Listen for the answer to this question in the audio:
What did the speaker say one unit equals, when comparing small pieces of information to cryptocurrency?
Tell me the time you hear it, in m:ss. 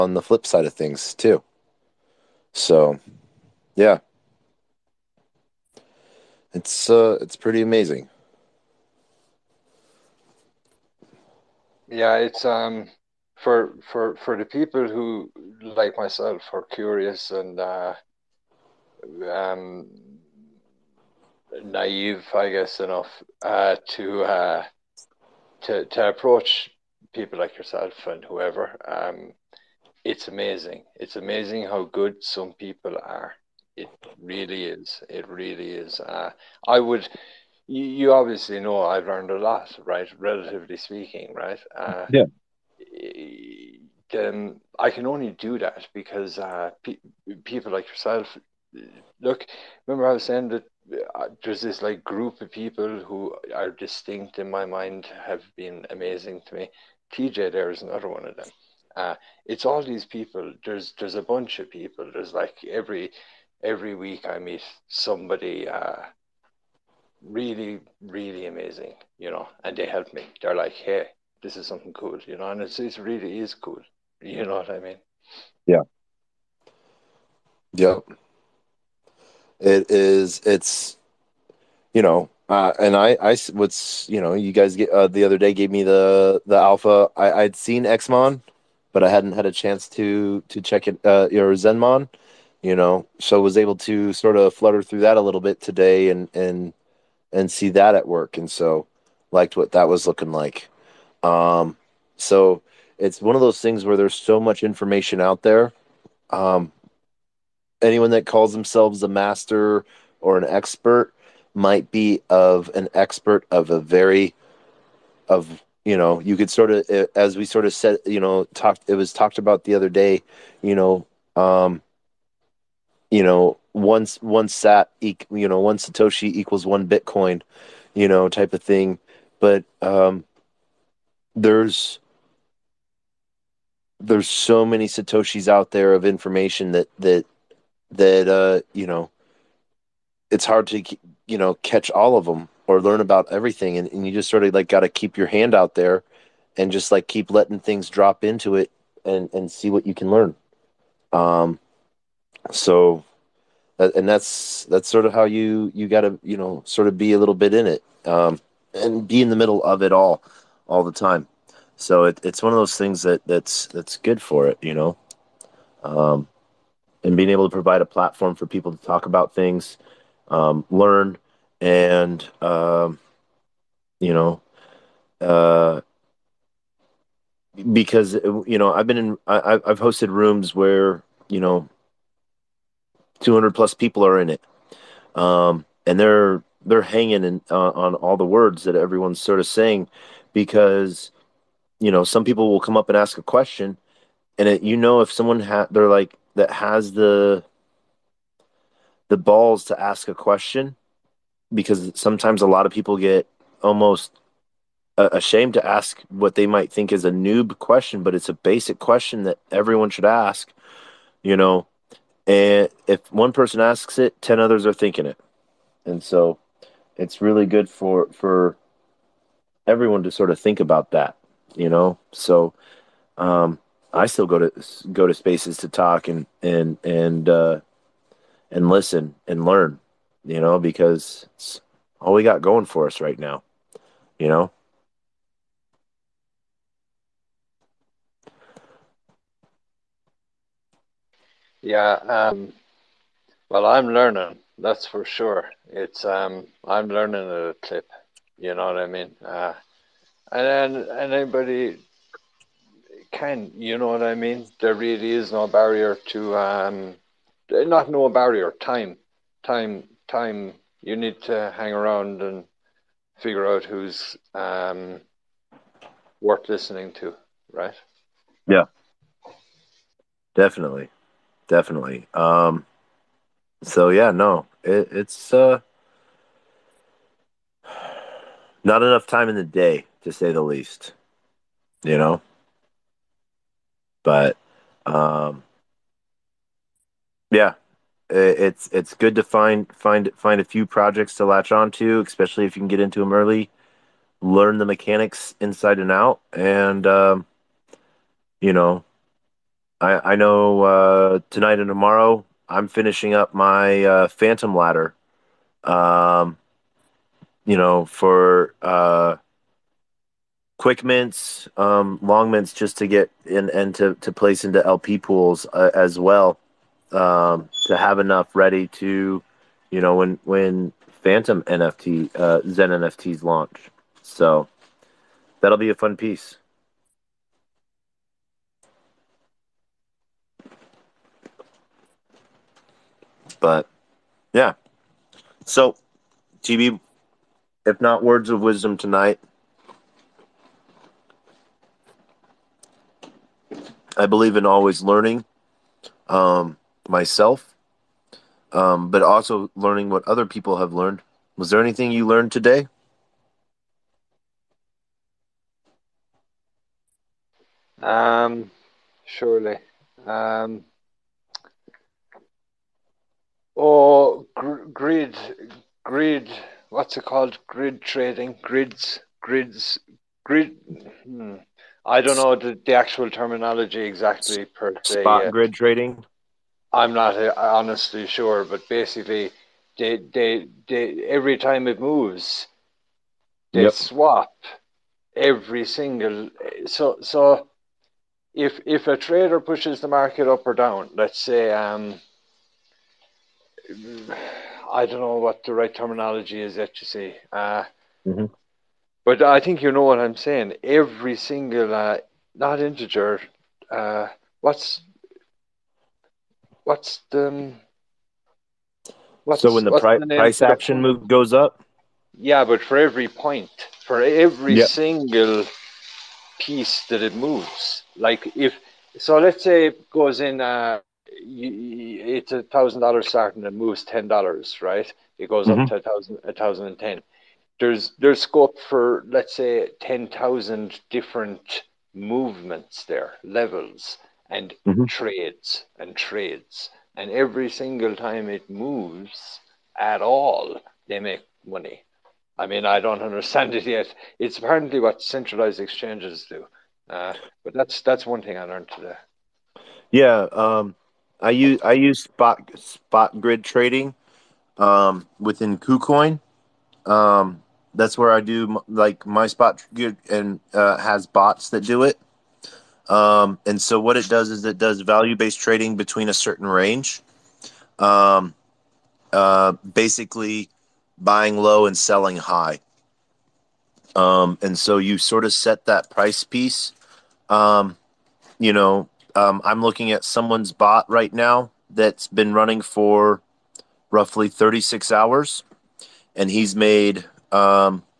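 2:06.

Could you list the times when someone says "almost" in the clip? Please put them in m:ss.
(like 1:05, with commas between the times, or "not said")
3:23.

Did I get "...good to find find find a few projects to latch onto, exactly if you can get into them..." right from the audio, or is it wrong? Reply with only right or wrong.
wrong.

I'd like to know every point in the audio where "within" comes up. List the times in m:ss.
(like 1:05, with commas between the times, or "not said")
7:35.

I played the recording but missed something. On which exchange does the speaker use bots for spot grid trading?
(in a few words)
KuCoin.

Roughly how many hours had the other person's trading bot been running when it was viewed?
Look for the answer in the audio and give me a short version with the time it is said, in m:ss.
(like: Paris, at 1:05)
36 hours, at 8:04.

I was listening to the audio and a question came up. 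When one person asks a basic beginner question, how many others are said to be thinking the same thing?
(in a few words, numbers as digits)
10.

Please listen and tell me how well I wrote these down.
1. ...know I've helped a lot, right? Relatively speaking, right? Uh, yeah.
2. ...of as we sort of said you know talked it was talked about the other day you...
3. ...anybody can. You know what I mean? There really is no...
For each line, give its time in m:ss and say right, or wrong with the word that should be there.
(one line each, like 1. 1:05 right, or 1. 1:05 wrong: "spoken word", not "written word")
1. 0:38 wrong: "learned", not "helped"
2. 1:56 right
3. 4:11 right.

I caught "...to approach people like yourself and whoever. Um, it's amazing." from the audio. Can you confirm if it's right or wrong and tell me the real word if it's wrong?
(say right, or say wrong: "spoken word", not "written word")
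right.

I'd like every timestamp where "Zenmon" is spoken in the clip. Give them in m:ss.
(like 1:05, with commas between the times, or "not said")
1:31.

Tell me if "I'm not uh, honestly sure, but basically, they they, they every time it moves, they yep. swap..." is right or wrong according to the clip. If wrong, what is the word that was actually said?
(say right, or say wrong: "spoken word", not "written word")
right.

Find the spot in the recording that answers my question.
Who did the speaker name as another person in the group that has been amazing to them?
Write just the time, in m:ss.
0:57.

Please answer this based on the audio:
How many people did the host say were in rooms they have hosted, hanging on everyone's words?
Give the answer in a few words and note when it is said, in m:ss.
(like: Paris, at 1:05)
200 plus, at 3:03.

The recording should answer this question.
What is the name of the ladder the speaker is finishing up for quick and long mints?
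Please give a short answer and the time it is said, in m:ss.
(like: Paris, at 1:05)
Phantom Ladder, at 5:04.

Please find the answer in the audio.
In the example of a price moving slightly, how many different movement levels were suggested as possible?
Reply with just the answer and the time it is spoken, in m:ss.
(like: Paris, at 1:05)
ten thousand, at 7:09.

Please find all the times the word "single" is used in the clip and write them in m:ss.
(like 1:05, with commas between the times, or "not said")
6:25, 6:41, 6:54, 7:17.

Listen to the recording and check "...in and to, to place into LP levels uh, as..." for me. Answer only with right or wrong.
wrong.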